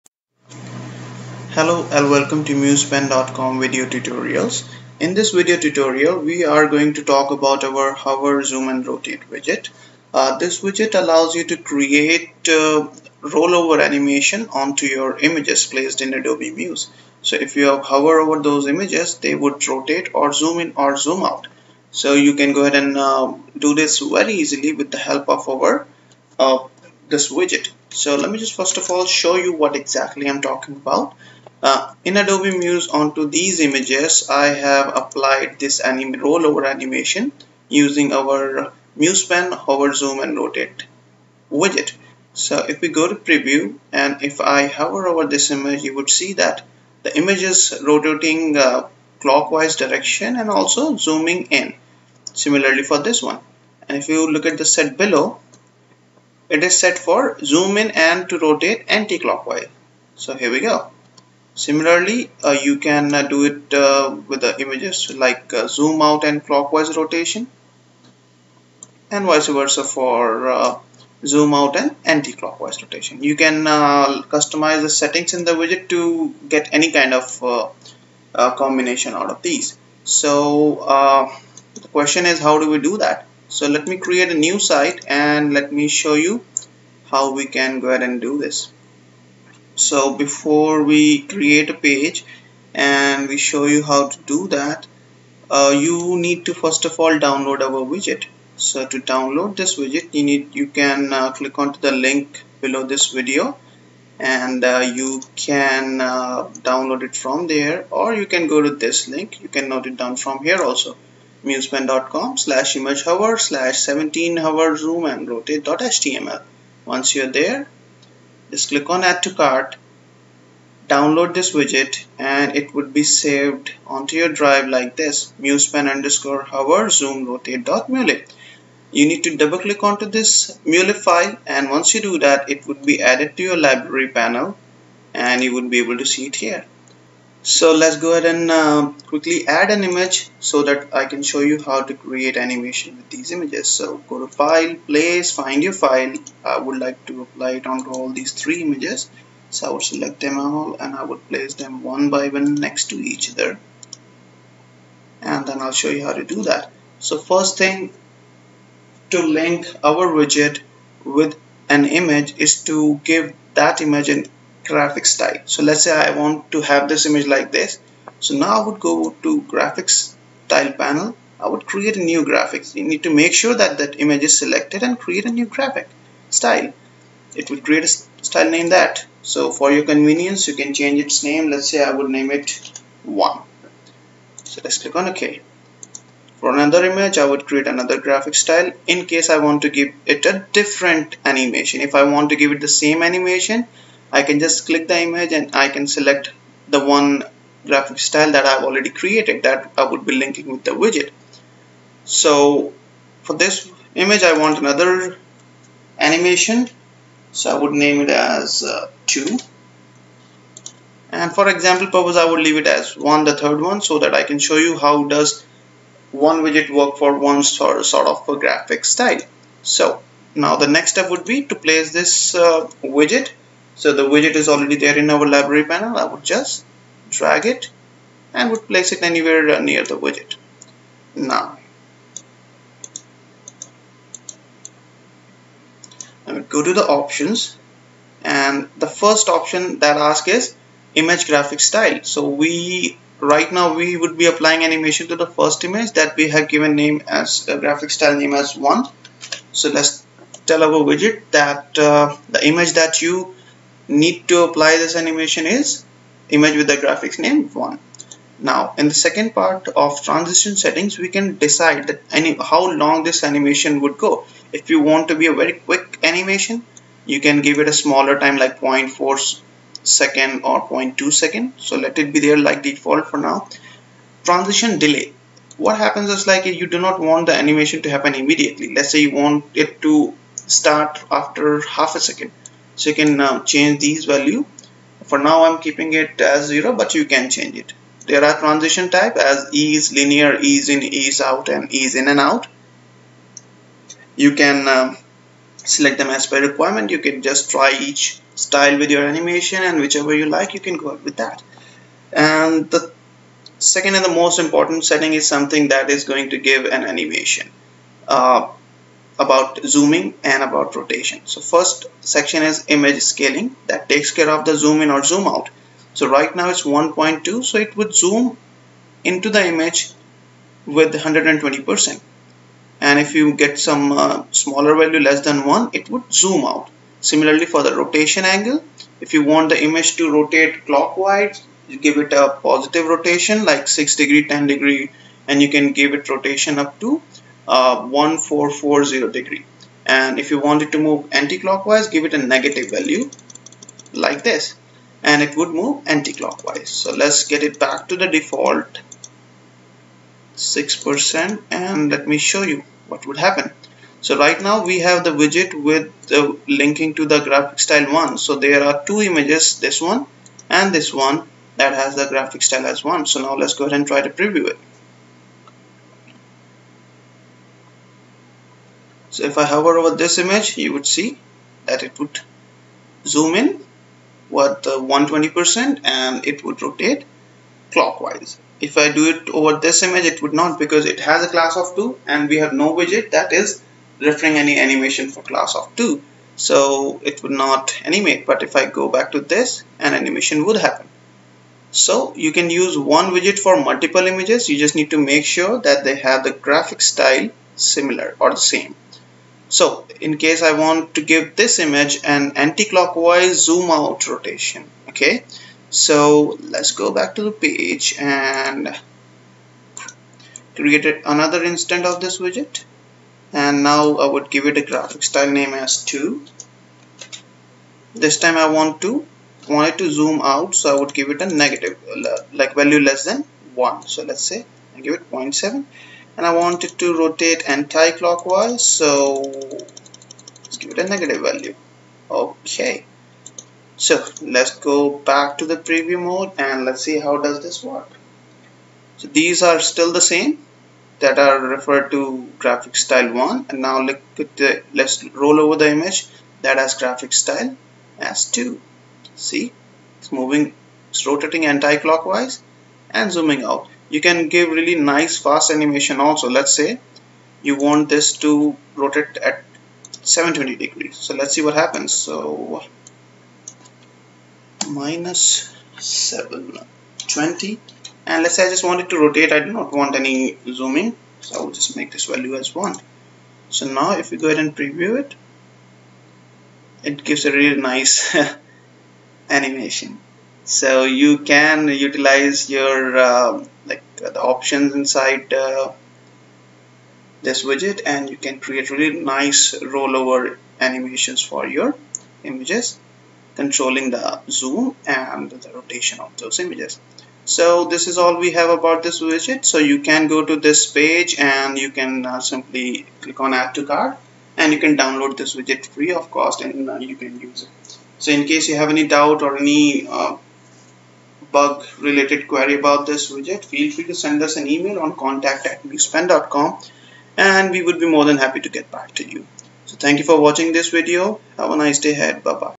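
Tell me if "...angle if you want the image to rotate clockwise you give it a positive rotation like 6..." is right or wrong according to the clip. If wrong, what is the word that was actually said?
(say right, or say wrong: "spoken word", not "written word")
right.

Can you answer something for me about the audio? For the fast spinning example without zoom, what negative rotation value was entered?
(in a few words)
-720.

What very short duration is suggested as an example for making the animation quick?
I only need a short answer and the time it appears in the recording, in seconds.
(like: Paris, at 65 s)
0.2 seconds, at 270 s.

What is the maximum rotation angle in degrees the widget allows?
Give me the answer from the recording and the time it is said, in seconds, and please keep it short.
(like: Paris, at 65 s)
1440, at 337 s.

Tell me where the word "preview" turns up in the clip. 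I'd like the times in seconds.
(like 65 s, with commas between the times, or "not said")
43 s, 364 s, 435 s, 474 s.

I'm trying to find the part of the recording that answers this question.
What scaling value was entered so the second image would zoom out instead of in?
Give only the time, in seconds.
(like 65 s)
425 s.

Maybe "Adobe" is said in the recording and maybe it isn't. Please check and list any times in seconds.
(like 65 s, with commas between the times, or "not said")
16 s, 32 s.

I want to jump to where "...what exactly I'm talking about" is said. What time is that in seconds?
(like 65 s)
29 s.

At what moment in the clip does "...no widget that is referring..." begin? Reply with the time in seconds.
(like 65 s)
382 s.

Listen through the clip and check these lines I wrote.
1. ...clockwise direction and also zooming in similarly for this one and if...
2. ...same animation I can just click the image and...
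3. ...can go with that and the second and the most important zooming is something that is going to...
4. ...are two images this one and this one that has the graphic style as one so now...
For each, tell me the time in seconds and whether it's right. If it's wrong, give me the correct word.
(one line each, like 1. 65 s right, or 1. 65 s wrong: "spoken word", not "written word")
1. 49 s right
2. 192 s right
3. 300 s wrong: "setting", not "zooming"
4. 358 s right.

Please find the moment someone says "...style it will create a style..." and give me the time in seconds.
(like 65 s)
176 s.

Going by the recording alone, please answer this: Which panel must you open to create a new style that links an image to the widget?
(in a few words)
graphics style panel.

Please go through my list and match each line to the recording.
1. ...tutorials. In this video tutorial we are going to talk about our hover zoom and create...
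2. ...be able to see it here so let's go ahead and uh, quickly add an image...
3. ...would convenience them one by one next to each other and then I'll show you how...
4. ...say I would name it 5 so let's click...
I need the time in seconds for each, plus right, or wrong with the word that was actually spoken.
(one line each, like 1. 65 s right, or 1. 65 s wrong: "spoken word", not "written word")
1. 3 s wrong: "rotate", not "create"
2. 135 s right
3. 151 s wrong: "place", not "convenience"
4. 181 s wrong: "1", not "5".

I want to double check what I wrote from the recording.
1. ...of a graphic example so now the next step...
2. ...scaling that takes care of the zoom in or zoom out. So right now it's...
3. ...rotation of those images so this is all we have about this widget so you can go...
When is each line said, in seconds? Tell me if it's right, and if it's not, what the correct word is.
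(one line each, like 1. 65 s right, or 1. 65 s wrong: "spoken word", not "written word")
1. 218 s wrong: "style", not "example"
2. 313 s right
3. 495 s right.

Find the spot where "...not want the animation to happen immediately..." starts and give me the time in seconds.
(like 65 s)
276 s.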